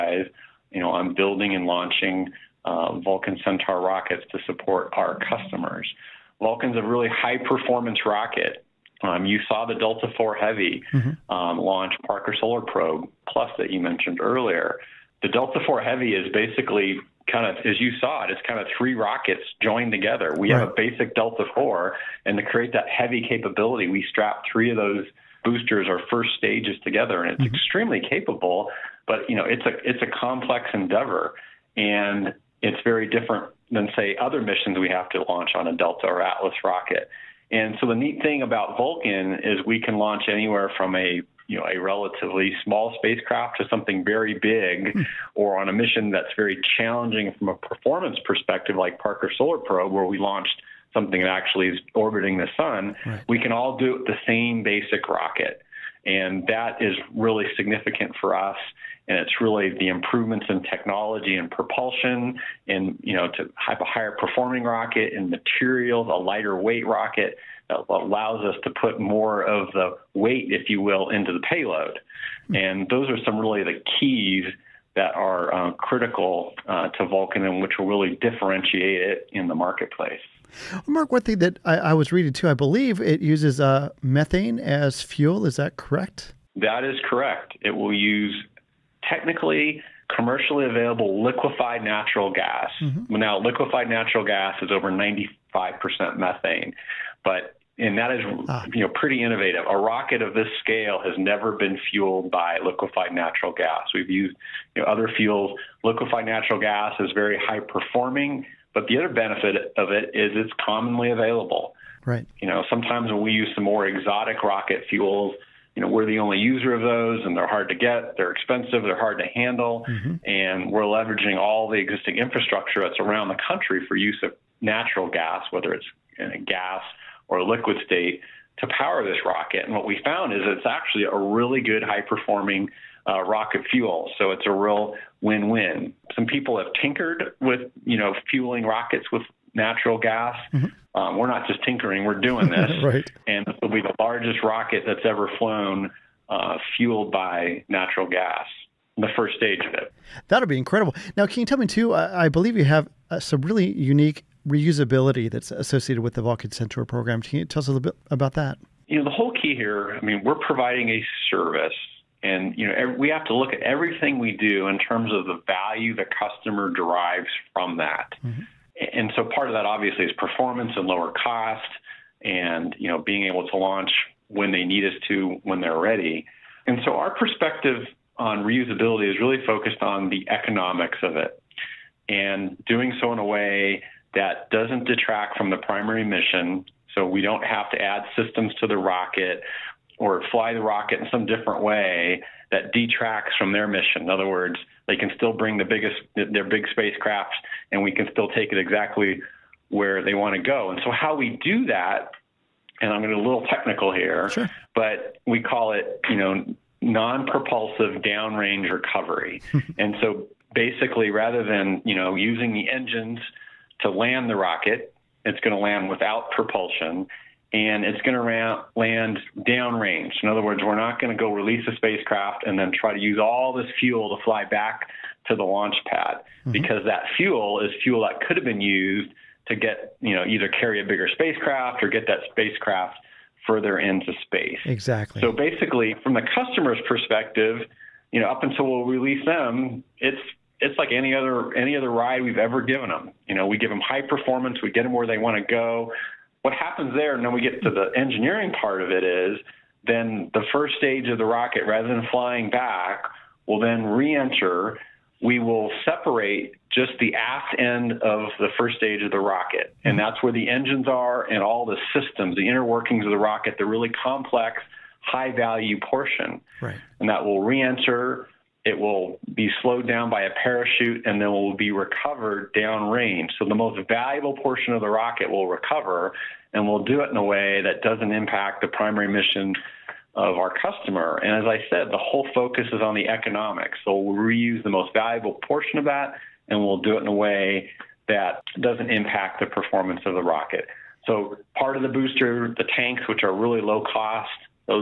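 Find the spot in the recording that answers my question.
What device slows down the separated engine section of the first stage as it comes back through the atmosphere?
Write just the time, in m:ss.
4:30.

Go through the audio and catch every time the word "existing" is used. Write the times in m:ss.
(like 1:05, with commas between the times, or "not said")
2:01.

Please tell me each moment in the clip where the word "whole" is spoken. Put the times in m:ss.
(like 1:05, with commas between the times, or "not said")
2:39, 4:41.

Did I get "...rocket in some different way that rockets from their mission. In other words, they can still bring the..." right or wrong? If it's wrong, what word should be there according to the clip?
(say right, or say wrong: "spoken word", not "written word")
wrong: "detracts", not "rockets".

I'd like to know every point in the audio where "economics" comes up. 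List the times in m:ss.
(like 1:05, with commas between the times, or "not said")
3:00, 4:43.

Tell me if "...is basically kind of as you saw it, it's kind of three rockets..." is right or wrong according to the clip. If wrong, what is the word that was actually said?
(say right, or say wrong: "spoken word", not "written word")
right.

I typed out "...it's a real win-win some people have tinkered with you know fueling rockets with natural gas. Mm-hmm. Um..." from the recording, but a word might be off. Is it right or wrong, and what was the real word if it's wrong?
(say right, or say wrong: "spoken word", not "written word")
right.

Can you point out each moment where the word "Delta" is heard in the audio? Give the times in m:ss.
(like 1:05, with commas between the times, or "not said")
0:09, 0:15, 0:21, 0:35.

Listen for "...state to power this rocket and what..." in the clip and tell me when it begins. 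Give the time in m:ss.
2:07.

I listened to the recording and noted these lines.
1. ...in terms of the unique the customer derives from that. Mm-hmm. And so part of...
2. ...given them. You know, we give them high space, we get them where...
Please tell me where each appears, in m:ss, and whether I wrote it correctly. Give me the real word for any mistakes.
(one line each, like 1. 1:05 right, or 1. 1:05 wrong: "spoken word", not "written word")
1. 2:44 wrong: "value", not "unique"
2. 4:02 wrong: "performance", not "space".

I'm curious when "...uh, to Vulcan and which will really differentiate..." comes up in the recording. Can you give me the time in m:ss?
1:16.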